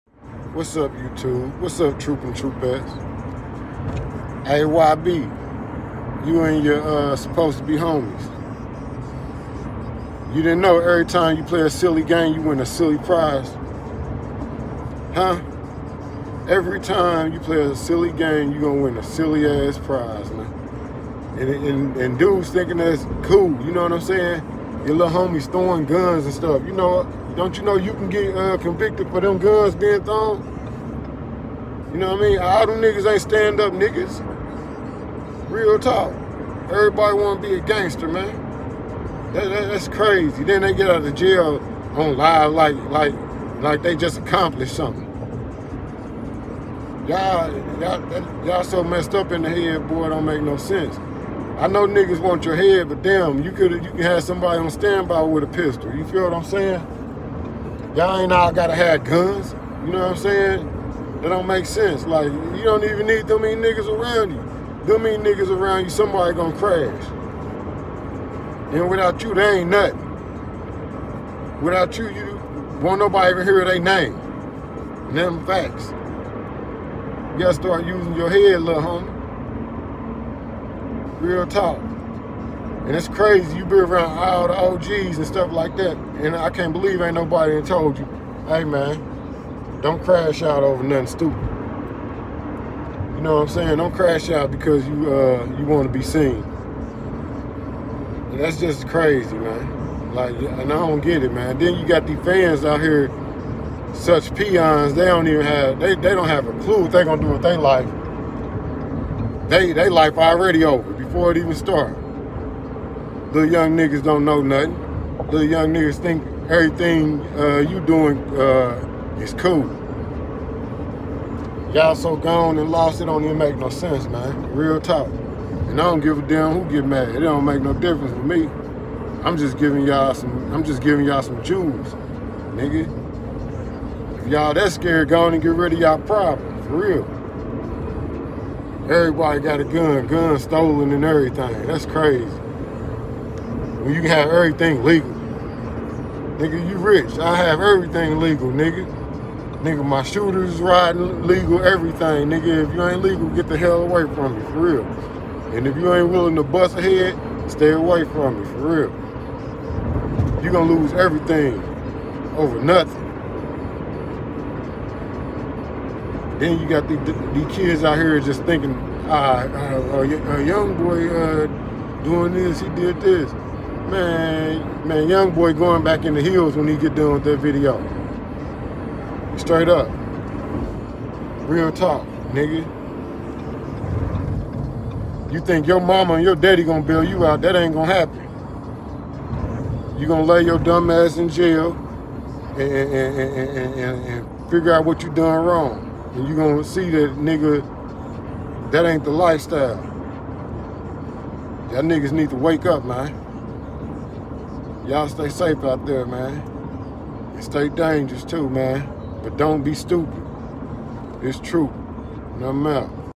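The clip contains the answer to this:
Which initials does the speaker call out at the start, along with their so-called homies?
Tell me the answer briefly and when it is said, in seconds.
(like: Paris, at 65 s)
AYB, at 4 s.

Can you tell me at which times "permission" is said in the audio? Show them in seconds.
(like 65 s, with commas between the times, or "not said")
not said.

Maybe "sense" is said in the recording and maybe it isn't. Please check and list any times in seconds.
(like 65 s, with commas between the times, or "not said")
50 s, 61 s, 123 s.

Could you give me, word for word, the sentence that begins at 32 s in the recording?
All them niggas ain't stand up niggas.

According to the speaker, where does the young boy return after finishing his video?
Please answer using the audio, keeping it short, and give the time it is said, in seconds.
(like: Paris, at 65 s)
The hills, at 176 s.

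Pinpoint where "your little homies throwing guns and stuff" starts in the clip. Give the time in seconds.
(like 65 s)
24 s.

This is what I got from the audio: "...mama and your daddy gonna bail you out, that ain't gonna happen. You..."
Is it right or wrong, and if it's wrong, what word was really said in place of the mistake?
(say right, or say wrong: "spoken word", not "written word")
right.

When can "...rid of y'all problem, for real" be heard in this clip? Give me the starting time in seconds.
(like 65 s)
135 s.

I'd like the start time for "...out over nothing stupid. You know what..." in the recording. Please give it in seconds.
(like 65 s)
90 s.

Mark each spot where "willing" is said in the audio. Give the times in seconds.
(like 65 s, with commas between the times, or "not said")
156 s.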